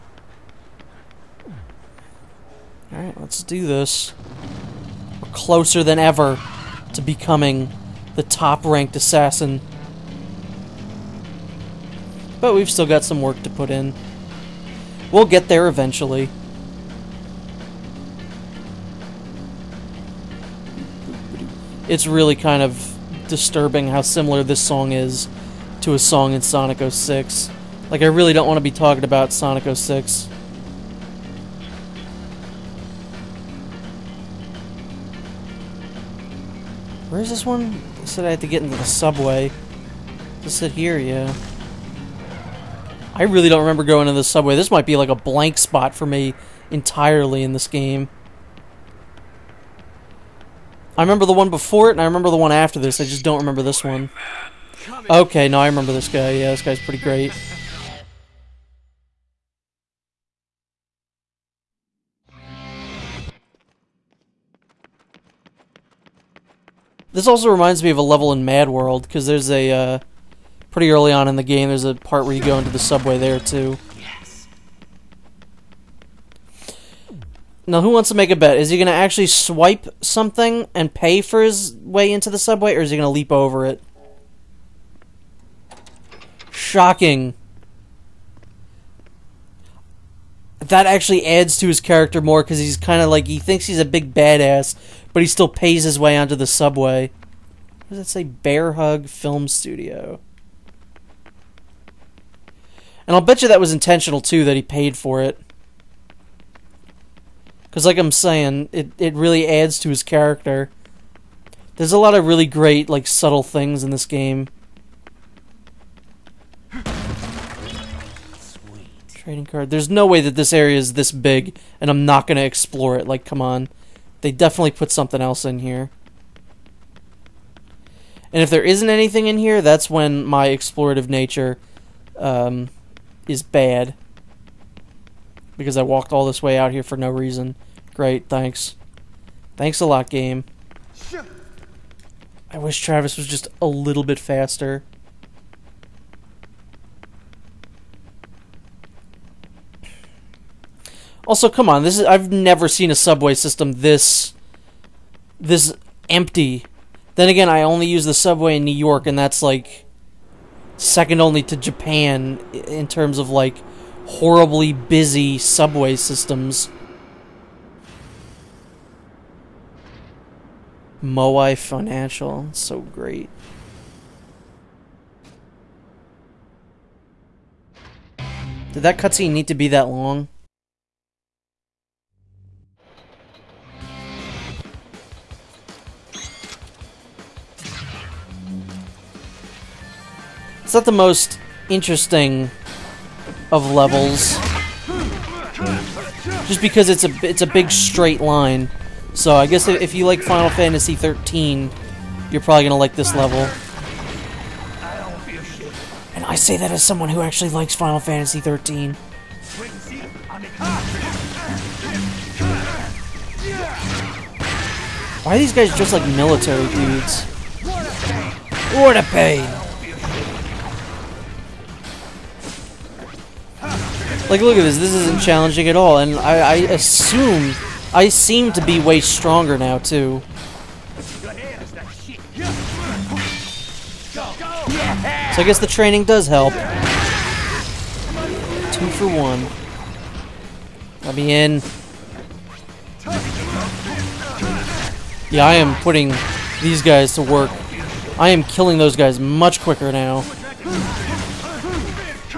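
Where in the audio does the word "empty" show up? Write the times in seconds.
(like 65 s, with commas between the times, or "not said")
156 s.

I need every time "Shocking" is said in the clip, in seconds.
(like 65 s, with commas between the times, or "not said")
86 s.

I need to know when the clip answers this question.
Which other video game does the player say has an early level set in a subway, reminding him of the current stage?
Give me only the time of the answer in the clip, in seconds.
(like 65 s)
68 s.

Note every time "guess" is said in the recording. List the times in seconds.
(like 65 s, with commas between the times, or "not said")
199 s, 235 s.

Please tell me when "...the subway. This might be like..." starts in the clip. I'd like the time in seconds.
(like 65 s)
44 s.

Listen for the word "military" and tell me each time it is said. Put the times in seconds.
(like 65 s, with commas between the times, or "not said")
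216 s.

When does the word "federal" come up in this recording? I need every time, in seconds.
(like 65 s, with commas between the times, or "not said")
not said.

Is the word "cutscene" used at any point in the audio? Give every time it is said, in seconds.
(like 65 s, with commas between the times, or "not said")
178 s.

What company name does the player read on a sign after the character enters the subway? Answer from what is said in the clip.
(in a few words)
Bear Hug Film Studio.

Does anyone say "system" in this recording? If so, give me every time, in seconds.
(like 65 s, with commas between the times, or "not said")
153 s, 165 s.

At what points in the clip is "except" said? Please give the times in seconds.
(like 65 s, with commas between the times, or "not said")
not said.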